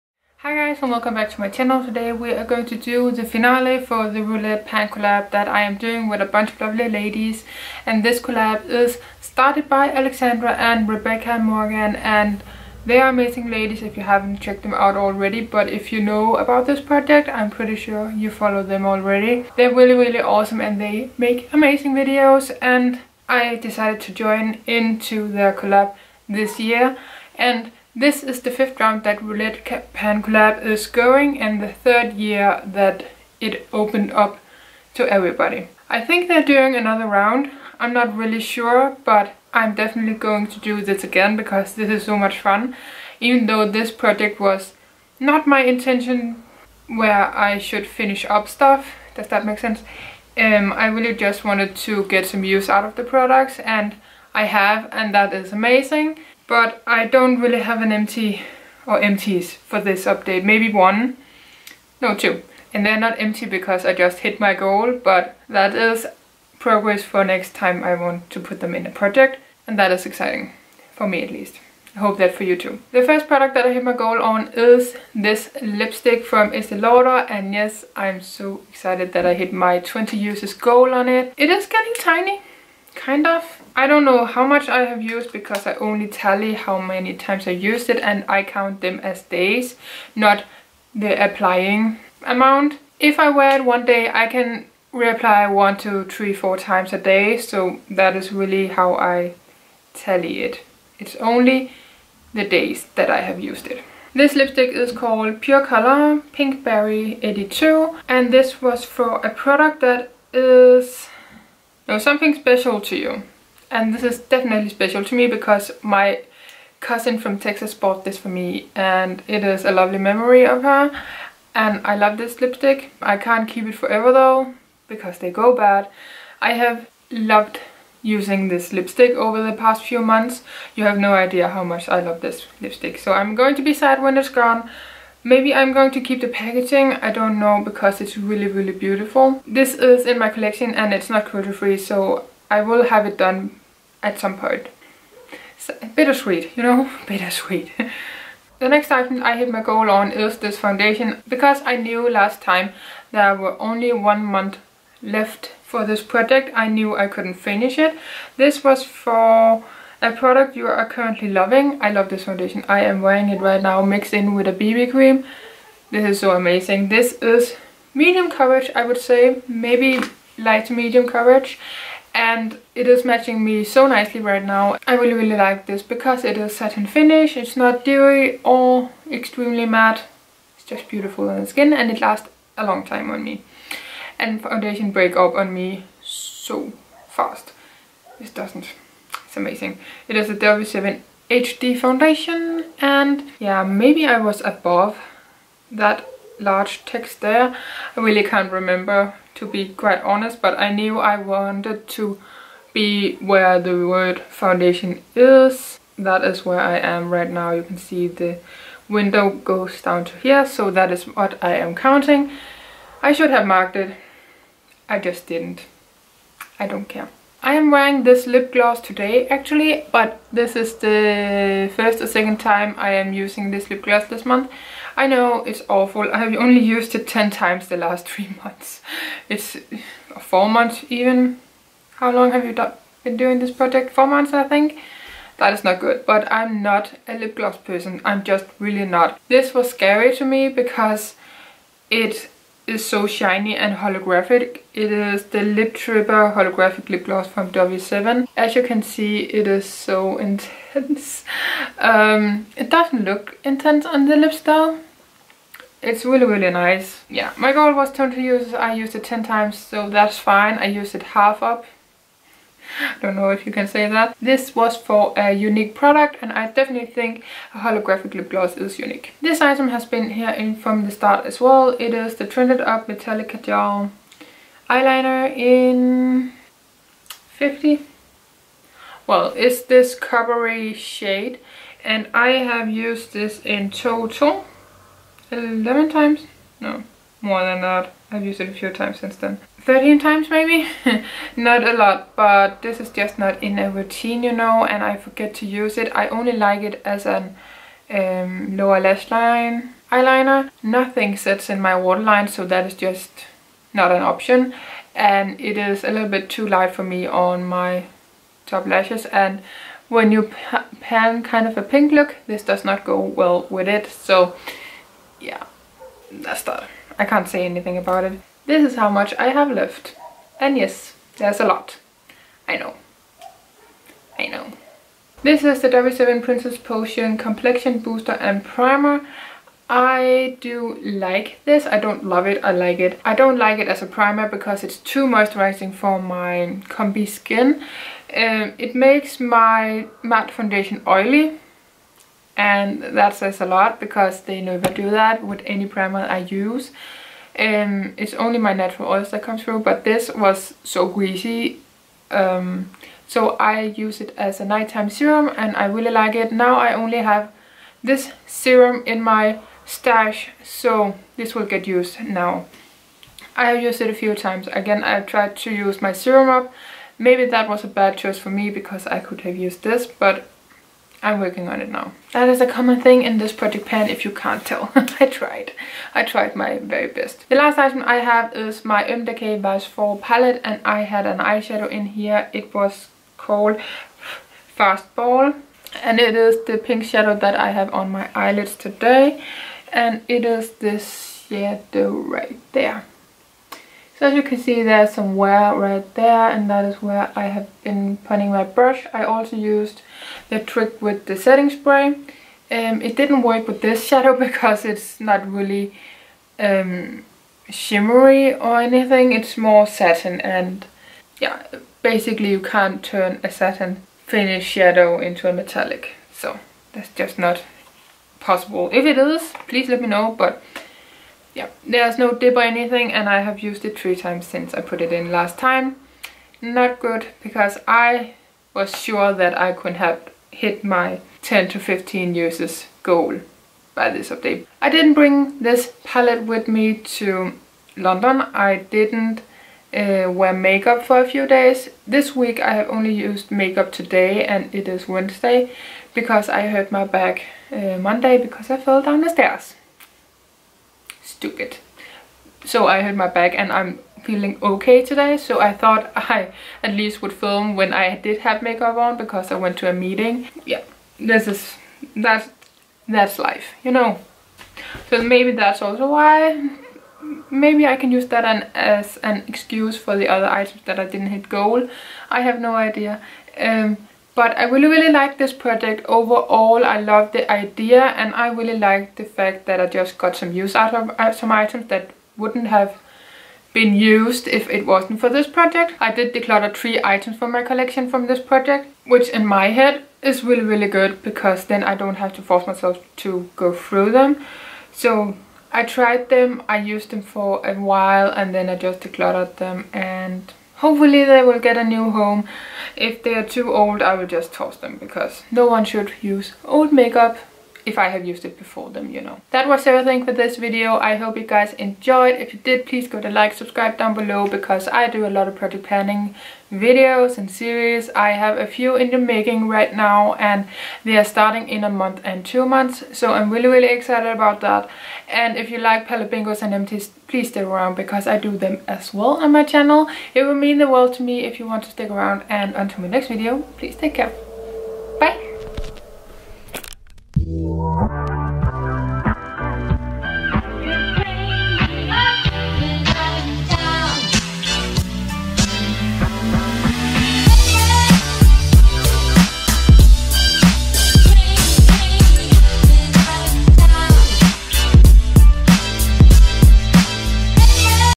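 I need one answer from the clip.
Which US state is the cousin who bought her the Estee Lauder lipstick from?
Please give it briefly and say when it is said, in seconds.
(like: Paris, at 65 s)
Texas, at 117 s.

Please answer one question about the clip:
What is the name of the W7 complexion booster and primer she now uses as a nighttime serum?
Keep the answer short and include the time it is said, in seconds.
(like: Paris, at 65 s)
Princess Potion, at 326 s.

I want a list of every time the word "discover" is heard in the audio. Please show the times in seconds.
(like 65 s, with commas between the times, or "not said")
not said.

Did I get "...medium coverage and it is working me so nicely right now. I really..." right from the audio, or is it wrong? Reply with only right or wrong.
wrong.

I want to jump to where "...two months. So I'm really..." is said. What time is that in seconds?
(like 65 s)
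522 s.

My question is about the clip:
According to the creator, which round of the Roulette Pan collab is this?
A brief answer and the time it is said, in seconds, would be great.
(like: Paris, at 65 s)
Fifth, at 28 s.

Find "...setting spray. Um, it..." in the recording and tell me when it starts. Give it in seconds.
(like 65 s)
401 s.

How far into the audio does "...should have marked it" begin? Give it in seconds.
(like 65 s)
213 s.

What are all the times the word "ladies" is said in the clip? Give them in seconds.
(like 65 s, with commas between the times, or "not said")
6 s, 13 s.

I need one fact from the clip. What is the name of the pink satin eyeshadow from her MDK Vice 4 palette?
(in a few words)
Fastball.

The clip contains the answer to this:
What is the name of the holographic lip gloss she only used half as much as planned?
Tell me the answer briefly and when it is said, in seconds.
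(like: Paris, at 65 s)
Lip Tripper, at 245 s.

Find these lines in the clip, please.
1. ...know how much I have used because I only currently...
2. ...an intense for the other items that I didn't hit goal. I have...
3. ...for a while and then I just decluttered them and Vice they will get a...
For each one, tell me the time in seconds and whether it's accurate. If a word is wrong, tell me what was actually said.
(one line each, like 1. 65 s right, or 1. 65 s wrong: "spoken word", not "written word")
1. 84 s wrong: "tally", not "currently"
2. 469 s wrong: "excuse", not "intense"
3. 497 s wrong: "Hopefully", not "Vice".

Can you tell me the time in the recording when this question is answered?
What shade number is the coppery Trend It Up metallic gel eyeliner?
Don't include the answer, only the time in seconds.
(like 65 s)
277 s.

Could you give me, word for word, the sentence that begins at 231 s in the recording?
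How long have you been doing this project?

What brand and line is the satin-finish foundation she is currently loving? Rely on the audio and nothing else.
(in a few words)
W7 HD.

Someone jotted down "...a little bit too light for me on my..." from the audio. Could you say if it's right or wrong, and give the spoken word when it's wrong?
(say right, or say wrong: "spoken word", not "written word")
right.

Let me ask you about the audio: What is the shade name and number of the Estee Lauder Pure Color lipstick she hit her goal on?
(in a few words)
Pink Berry 82.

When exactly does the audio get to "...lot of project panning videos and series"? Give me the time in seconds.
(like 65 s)
515 s.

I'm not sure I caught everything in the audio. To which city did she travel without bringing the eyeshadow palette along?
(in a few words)
London.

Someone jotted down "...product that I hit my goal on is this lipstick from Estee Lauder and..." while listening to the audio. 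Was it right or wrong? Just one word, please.
right.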